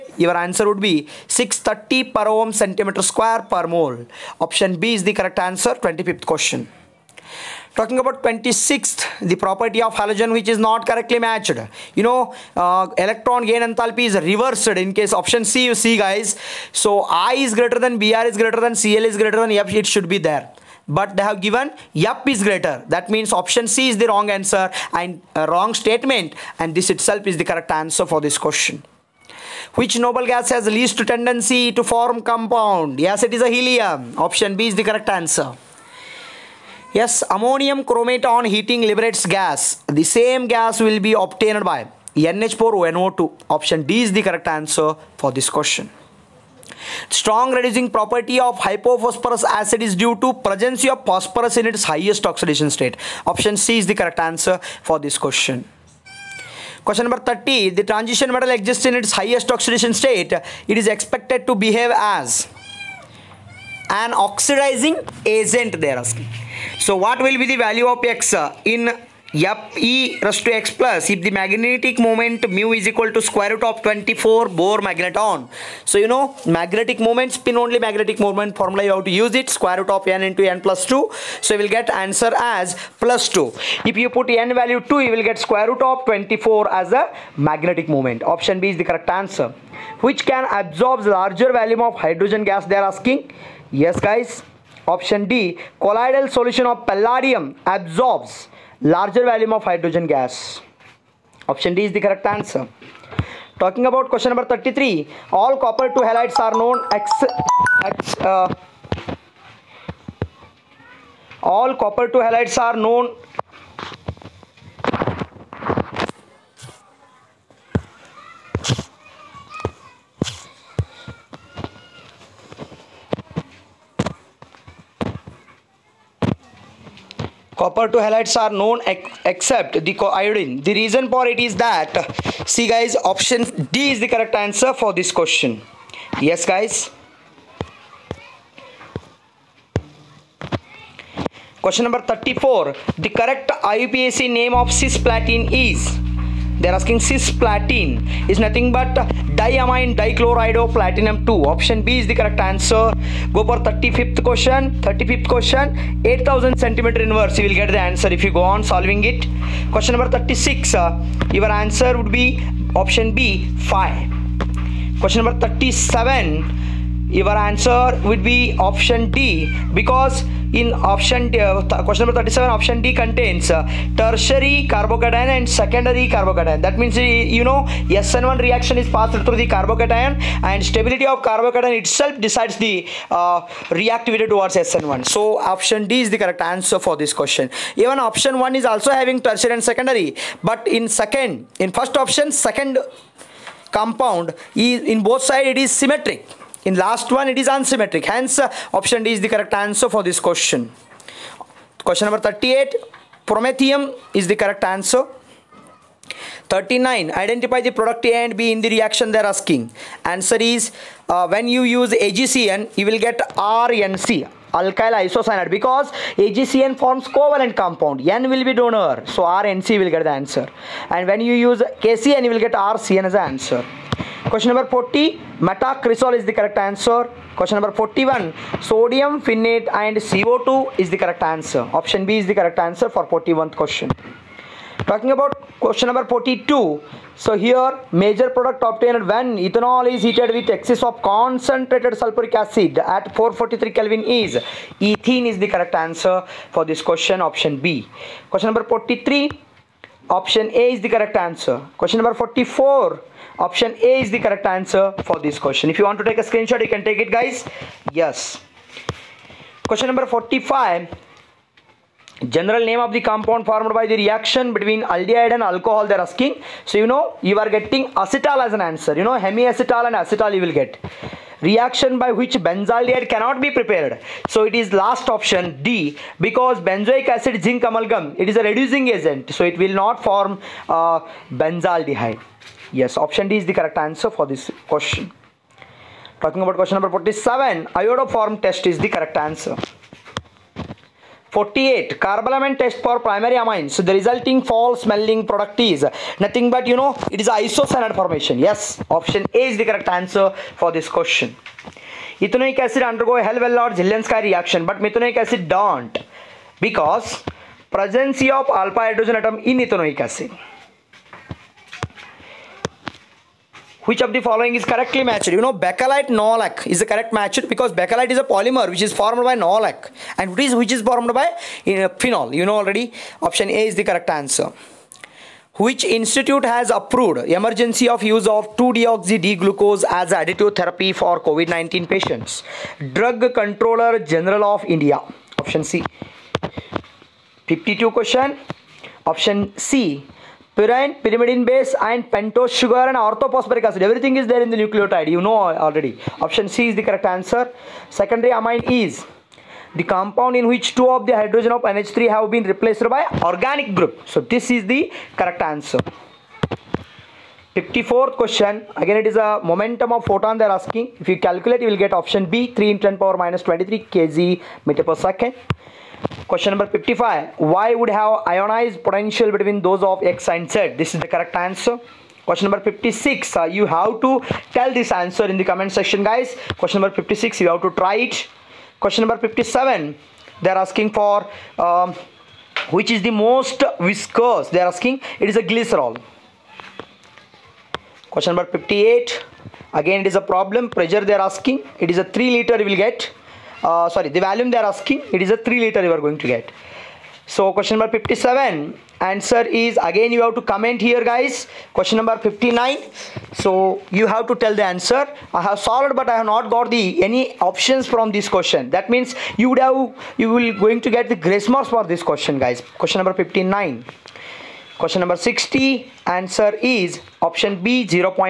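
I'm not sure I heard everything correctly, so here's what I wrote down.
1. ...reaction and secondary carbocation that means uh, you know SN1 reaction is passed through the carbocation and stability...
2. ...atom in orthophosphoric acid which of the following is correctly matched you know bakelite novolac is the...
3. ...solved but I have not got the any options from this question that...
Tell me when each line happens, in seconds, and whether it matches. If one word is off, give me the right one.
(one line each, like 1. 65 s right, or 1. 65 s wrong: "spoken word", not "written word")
1. 174 s wrong: "carbocation", not "reaction"
2. 309 s wrong: "ethanoic", not "orthophosphoric"
3. 405 s right.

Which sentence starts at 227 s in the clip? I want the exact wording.
Question number 41, sodium phenate and CO2 is the correct answer.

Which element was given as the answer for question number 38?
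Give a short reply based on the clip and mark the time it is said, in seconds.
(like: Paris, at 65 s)
Promethium, at 203 s.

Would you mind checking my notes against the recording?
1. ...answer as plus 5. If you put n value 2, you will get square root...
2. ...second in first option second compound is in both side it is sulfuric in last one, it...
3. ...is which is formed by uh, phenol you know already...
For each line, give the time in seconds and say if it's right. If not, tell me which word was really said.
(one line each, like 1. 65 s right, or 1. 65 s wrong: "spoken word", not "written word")
1. 81 s wrong: "2", not "5"
2. 190 s wrong: "symmetric", not "sulfuric"
3. 320 s right.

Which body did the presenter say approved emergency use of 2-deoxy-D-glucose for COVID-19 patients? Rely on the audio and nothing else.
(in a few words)
Drug Controller General of India.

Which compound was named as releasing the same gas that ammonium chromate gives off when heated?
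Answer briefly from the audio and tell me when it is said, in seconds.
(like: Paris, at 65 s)
NH4NO2, at 42 s.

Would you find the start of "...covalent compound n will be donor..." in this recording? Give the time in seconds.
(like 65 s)
217 s.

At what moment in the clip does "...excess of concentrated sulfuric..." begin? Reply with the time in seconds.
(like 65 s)
240 s.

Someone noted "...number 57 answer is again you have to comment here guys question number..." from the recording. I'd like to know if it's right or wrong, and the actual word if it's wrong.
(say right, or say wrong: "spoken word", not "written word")
right.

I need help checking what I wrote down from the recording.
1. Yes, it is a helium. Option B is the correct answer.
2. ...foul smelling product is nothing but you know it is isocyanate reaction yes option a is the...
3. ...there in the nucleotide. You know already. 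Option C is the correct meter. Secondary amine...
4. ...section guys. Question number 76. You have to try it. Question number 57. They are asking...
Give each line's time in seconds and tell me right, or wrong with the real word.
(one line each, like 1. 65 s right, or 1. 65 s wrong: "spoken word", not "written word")
1. 32 s right
2. 294 s wrong: "formation", not "reaction"
3. 344 s wrong: "answer", not "meter"
4. 375 s wrong: "56", not "76".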